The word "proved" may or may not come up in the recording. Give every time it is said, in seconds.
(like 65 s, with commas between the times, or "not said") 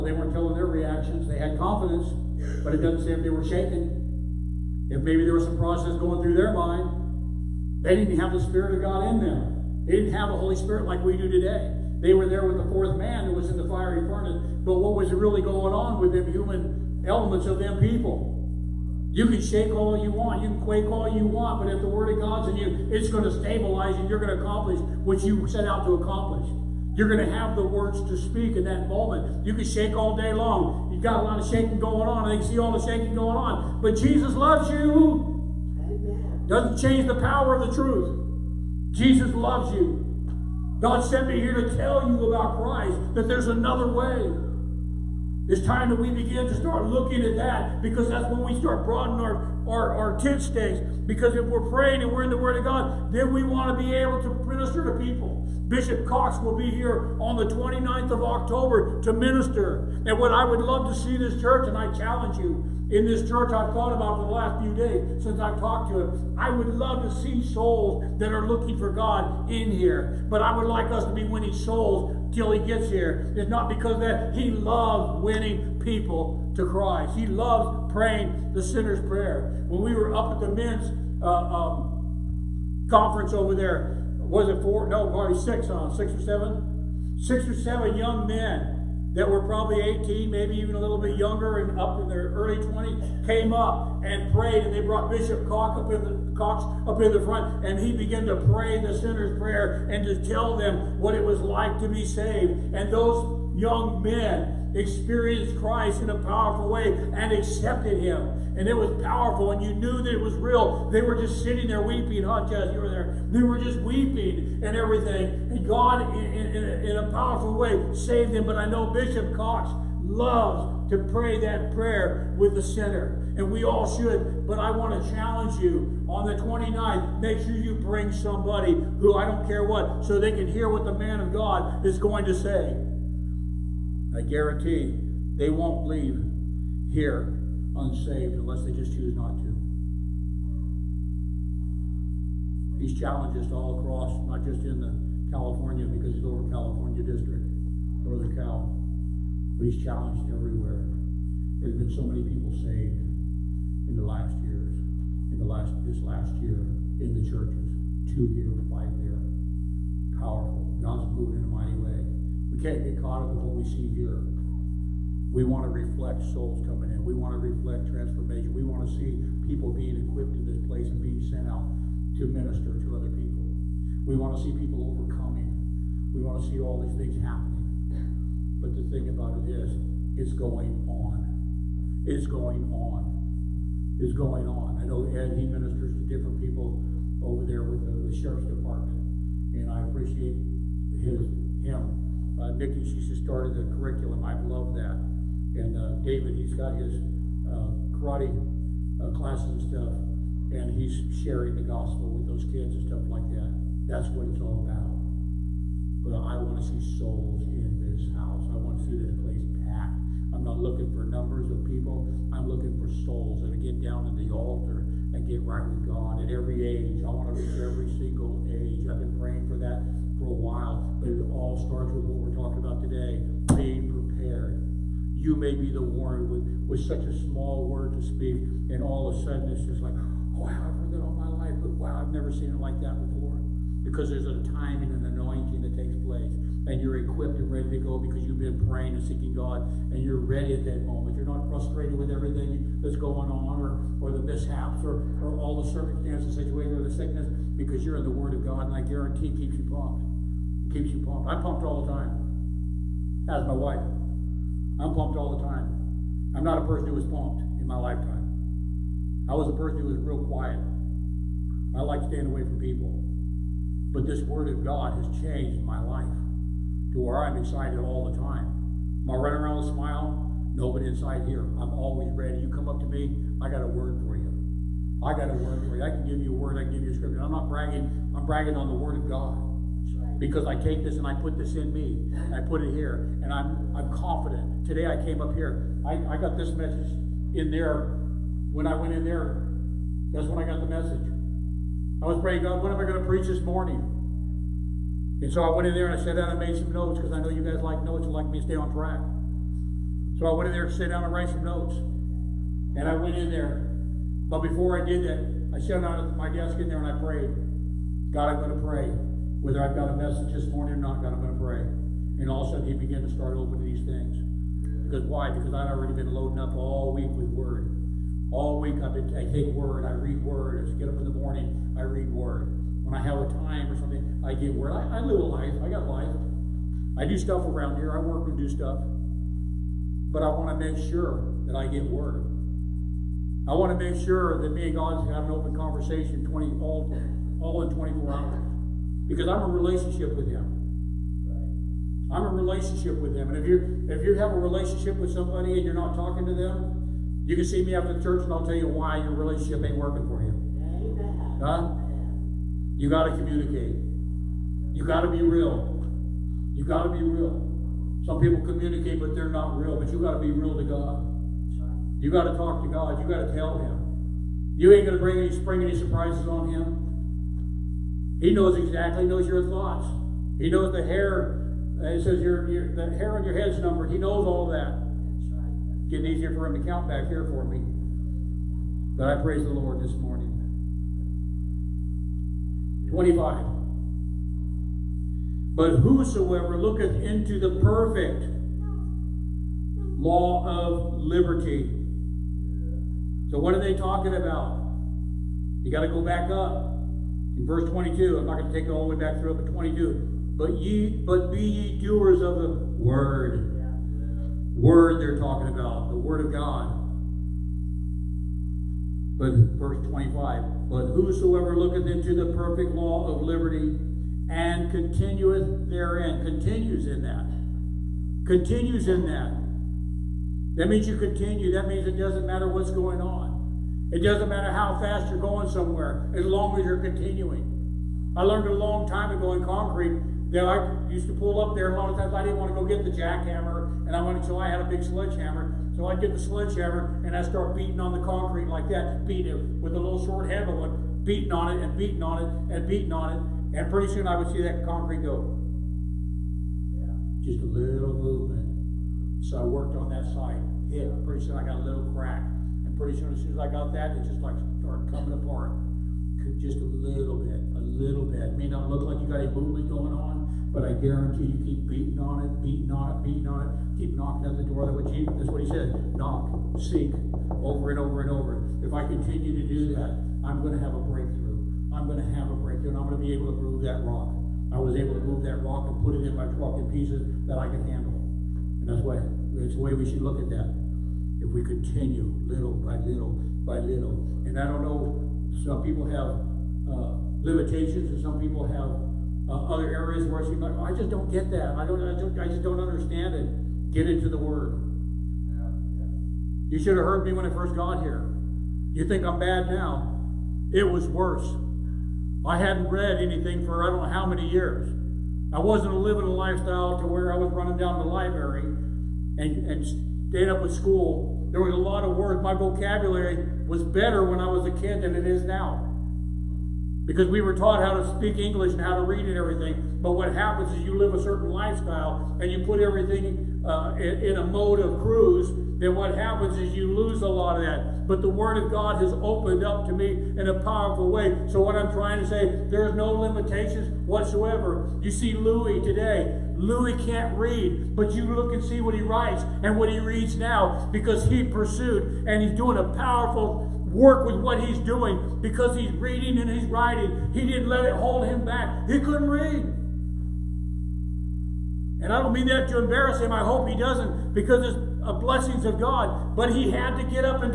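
not said.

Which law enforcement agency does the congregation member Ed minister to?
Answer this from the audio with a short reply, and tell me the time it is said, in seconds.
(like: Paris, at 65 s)
sheriff's department, at 188 s.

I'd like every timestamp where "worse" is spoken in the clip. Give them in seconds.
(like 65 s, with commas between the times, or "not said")
500 s.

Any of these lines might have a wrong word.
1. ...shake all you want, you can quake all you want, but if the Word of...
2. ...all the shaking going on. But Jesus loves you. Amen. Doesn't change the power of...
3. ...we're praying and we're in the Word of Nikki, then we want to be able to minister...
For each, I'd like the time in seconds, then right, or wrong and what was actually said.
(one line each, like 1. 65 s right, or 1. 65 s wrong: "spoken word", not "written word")
1. 19 s right
2. 32 s right
3. 51 s wrong: "God", not "Nikki".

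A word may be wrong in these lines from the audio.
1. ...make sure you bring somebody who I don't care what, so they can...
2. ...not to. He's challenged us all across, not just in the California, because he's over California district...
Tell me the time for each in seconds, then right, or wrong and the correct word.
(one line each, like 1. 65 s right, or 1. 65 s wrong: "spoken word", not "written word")
1. 127 s right
2. 139 s right.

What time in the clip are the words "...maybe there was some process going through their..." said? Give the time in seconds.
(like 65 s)
5 s.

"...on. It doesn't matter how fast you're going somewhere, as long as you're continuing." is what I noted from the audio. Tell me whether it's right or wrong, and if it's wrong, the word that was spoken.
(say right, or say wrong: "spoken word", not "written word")
right.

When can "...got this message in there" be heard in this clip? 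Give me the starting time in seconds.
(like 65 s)
286 s.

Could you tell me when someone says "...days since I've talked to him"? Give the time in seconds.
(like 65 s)
64 s.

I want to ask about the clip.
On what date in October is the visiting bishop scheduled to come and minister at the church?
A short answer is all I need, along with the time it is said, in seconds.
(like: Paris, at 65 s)
29th, at 57 s.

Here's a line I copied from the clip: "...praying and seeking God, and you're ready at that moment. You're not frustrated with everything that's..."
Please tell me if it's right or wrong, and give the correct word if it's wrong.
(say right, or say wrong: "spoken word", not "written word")
right.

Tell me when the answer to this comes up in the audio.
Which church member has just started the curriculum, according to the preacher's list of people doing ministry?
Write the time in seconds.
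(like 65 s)
192 s.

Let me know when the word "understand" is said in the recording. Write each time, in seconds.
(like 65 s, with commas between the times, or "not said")
492 s.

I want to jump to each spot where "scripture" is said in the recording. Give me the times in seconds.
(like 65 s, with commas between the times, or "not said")
276 s.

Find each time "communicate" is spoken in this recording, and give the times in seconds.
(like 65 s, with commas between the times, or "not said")
353 s, 358 s.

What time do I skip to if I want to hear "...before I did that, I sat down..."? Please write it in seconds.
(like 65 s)
304 s.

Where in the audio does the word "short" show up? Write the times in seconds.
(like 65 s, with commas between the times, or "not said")
440 s.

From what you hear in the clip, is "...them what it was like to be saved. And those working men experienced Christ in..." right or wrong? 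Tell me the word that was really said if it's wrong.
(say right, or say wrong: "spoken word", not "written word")
wrong: "young", not "working".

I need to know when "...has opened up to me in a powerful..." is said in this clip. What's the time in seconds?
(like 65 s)
528 s.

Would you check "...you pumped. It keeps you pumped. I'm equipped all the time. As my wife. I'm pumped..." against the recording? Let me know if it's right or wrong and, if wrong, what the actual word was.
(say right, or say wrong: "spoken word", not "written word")
wrong: "pumped", not "equipped".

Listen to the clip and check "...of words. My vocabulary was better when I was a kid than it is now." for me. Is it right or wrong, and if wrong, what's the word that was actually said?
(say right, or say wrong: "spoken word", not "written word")
right.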